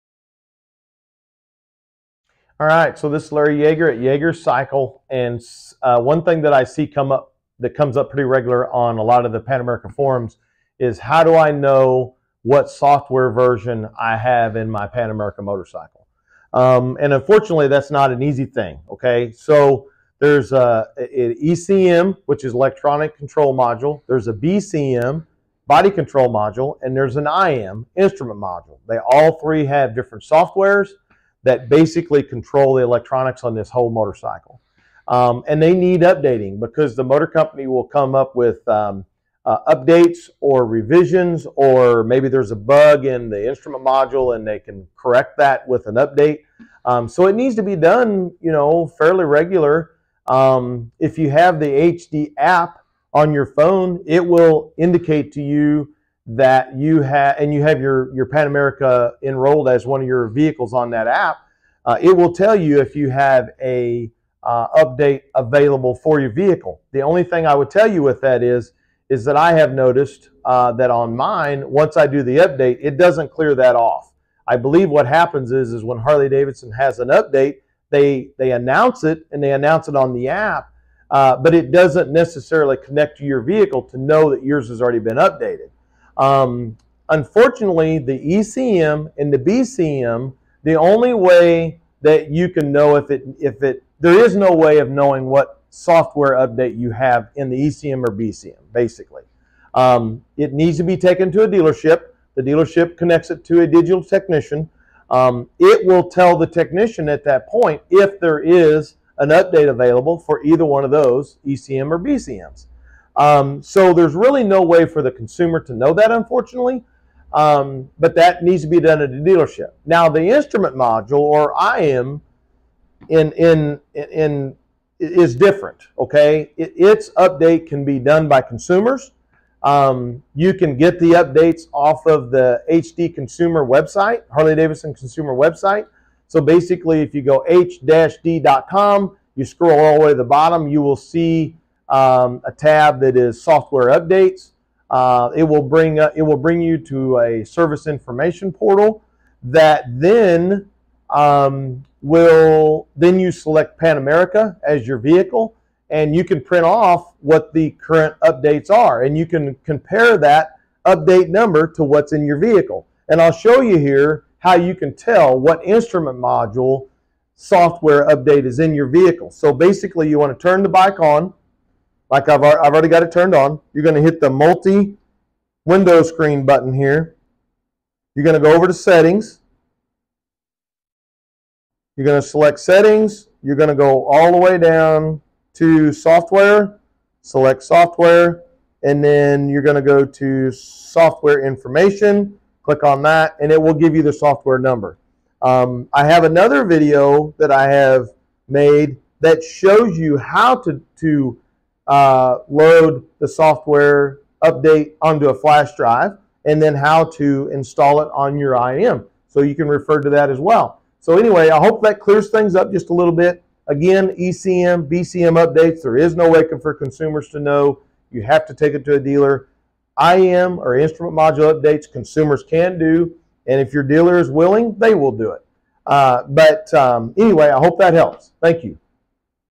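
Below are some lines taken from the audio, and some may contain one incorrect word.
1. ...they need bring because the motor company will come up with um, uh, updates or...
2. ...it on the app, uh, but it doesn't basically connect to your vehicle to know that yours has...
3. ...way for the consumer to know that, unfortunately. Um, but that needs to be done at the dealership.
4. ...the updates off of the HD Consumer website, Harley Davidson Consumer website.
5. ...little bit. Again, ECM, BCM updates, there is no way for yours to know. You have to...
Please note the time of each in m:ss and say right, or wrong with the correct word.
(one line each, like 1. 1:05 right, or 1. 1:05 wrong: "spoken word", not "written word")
1. 0:35 wrong: "updating", not "bring"
2. 1:19 wrong: "necessarily", not "basically"
3. 1:54 right
4. 2:10 right
5. 3:32 wrong: "consumers", not "yours".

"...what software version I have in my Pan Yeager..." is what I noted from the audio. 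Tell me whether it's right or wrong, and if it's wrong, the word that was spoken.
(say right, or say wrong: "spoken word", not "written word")
wrong: "American", not "Yeager".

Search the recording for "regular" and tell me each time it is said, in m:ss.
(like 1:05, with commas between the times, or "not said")
0:08, 0:49.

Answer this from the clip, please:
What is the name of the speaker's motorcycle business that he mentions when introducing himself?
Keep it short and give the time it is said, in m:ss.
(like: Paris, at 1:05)
Yeager Cycle, at 0:03.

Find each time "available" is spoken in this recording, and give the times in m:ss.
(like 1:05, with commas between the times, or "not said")
1:05, 1:49.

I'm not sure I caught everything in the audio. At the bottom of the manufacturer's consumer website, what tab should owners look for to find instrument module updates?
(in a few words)
software updates.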